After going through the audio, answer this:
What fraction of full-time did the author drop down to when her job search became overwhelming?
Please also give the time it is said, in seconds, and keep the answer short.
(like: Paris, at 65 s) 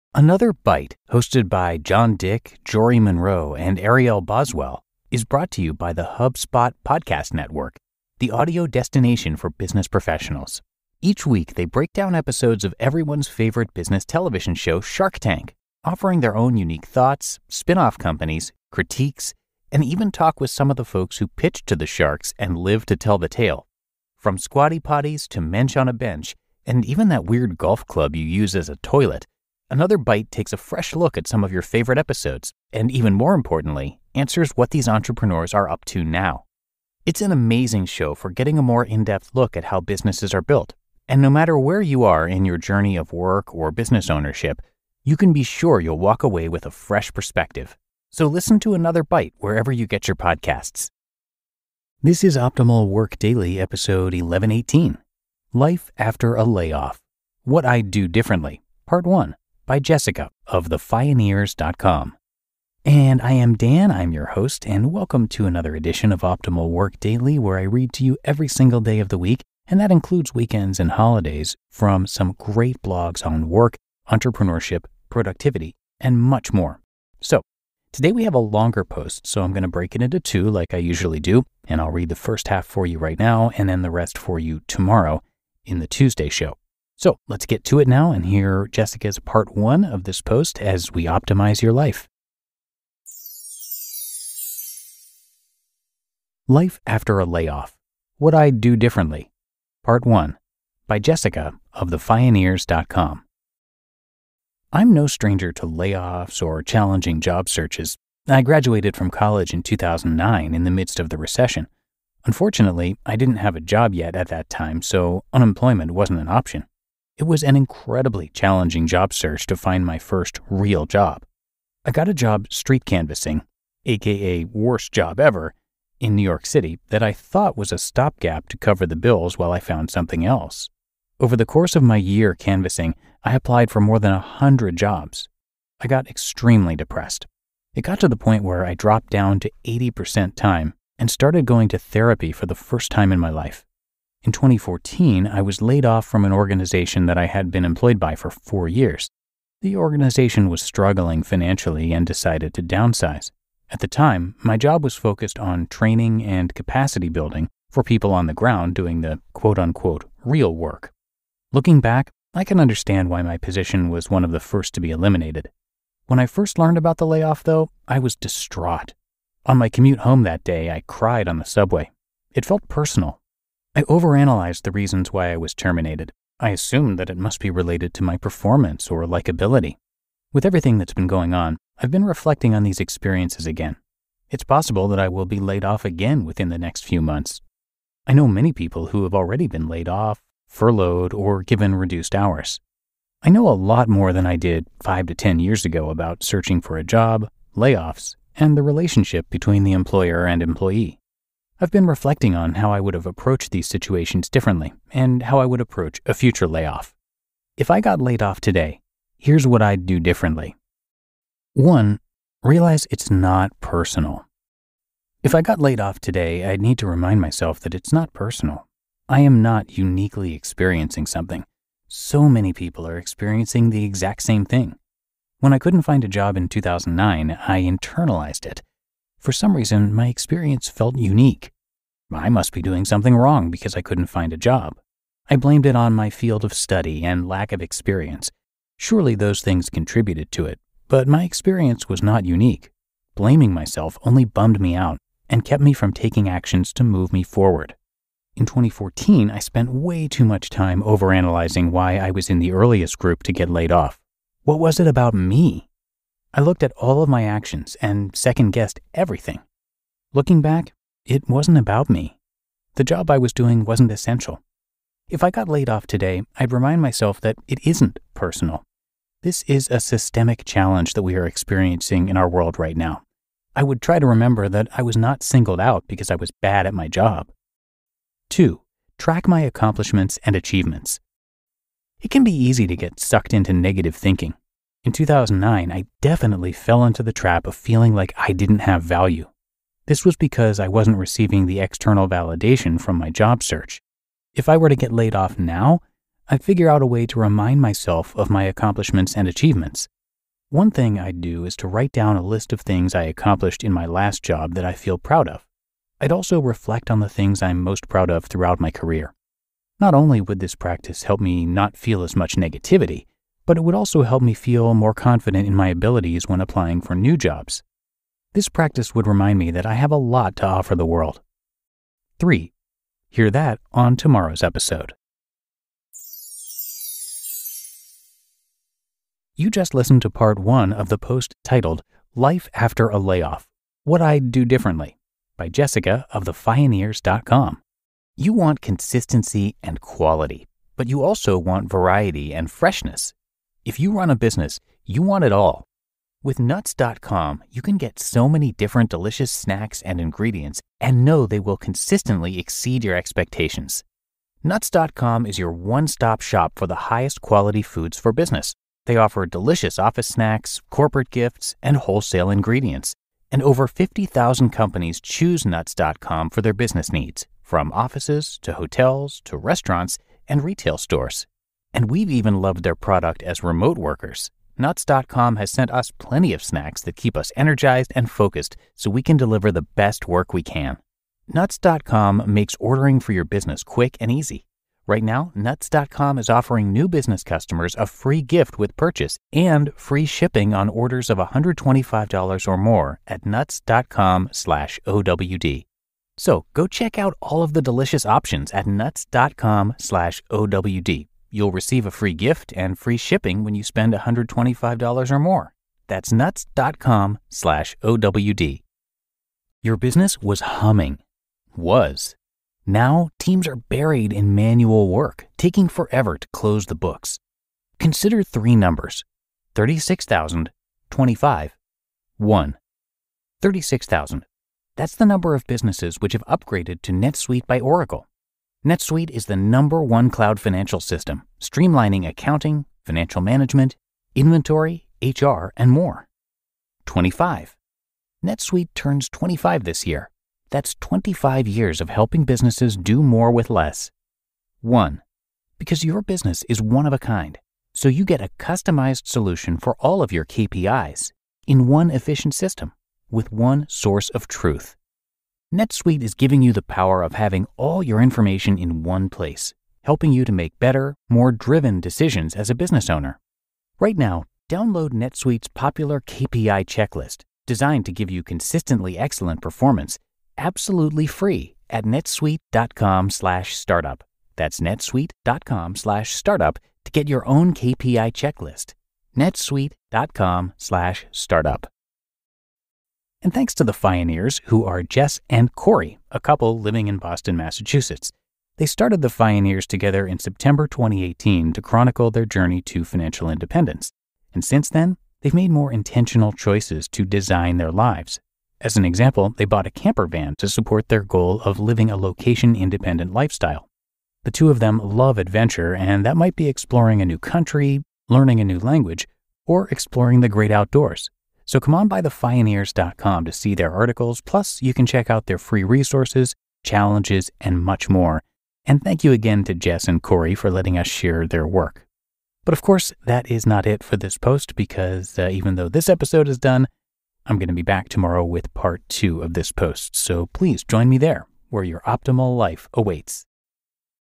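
80%, at 139 s.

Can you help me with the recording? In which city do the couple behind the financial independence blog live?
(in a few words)
Boston.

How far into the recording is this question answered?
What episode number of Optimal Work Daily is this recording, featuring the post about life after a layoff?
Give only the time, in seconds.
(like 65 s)
54 s.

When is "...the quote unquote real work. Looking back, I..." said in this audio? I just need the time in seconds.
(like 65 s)
159 s.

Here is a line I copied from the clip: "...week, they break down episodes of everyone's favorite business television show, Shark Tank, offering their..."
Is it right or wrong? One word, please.
right.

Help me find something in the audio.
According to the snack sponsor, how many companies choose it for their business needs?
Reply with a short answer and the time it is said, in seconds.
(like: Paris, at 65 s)
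Over 50,000, at 363 s.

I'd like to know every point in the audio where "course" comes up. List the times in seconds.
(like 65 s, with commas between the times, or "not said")
131 s, 522 s.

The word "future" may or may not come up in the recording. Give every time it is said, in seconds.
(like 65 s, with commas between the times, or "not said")
206 s.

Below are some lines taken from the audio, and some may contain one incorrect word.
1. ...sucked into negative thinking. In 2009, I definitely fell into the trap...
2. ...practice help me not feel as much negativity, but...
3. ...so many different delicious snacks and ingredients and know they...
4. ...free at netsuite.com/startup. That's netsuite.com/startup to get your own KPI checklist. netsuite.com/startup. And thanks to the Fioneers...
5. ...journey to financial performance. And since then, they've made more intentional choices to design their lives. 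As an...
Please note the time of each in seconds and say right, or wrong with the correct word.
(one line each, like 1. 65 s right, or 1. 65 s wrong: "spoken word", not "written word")
1. 283 s right
2. 310 s right
3. 347 s right
4. 471 s right
5. 492 s wrong: "independence", not "performance".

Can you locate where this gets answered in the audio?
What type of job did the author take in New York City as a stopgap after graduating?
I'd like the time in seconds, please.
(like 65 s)
122 s.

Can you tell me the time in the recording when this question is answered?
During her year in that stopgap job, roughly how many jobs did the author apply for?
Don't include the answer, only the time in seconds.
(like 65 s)
133 s.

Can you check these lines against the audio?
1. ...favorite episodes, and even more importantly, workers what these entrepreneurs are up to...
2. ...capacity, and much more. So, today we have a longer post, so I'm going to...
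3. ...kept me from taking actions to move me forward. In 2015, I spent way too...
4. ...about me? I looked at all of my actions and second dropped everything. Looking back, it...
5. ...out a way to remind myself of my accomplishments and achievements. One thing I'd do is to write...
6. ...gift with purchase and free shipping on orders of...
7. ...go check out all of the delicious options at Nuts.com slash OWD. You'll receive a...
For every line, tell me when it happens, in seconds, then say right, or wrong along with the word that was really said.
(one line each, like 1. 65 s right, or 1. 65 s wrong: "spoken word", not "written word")
1. 31 s wrong: "answers", not "workers"
2. 75 s wrong: "productivity", not "capacity"
3. 245 s wrong: "2014", not "2015"
4. 254 s wrong: "guessed", not "dropped"
5. 296 s right
6. 388 s right
7. 396 s right.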